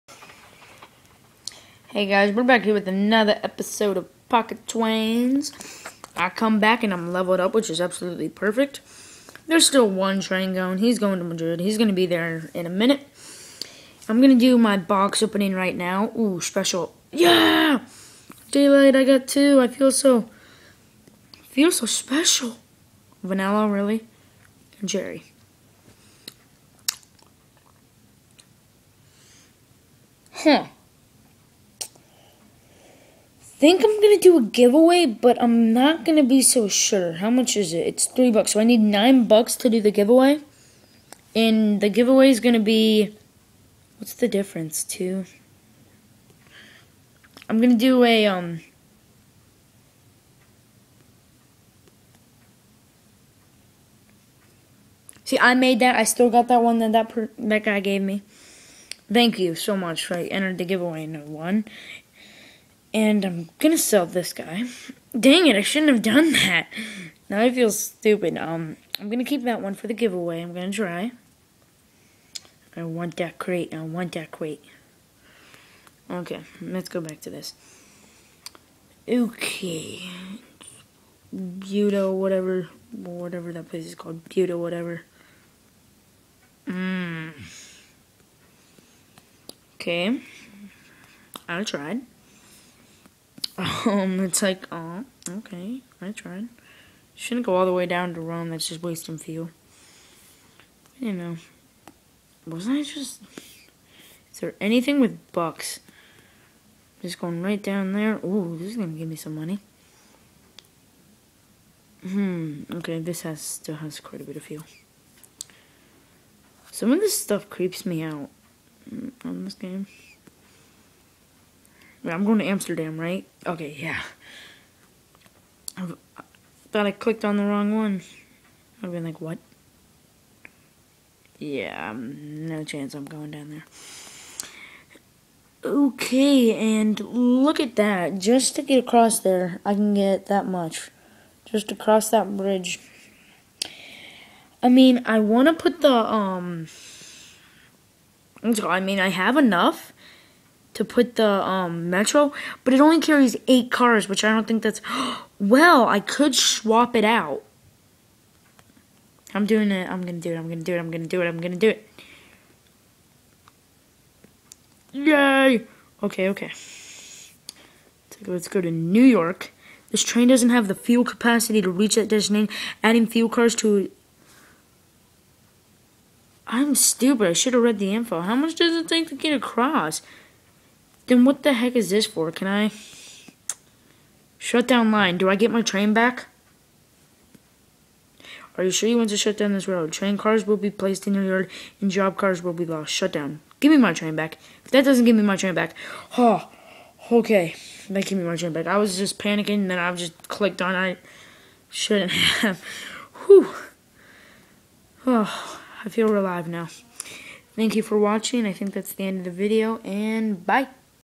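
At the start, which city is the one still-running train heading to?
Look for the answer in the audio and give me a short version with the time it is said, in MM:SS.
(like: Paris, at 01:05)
Madrid, at 00:11.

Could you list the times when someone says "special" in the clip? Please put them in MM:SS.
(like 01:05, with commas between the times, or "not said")
00:16, 00:21.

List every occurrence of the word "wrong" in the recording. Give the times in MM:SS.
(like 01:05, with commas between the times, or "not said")
02:07.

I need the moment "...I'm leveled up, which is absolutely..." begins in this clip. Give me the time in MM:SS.
00:06.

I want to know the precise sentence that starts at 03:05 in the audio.
Do I get my train back?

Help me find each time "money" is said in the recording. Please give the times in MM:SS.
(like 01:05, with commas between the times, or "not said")
01:49.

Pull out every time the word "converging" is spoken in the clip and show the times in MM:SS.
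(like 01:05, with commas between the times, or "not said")
not said.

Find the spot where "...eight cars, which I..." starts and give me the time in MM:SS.
02:33.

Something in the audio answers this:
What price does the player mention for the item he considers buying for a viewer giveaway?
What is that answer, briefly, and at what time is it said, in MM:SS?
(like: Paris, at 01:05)
3 bucks, at 00:38.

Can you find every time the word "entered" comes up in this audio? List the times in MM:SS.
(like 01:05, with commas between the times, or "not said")
01:00.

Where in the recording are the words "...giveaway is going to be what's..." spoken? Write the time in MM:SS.
00:41.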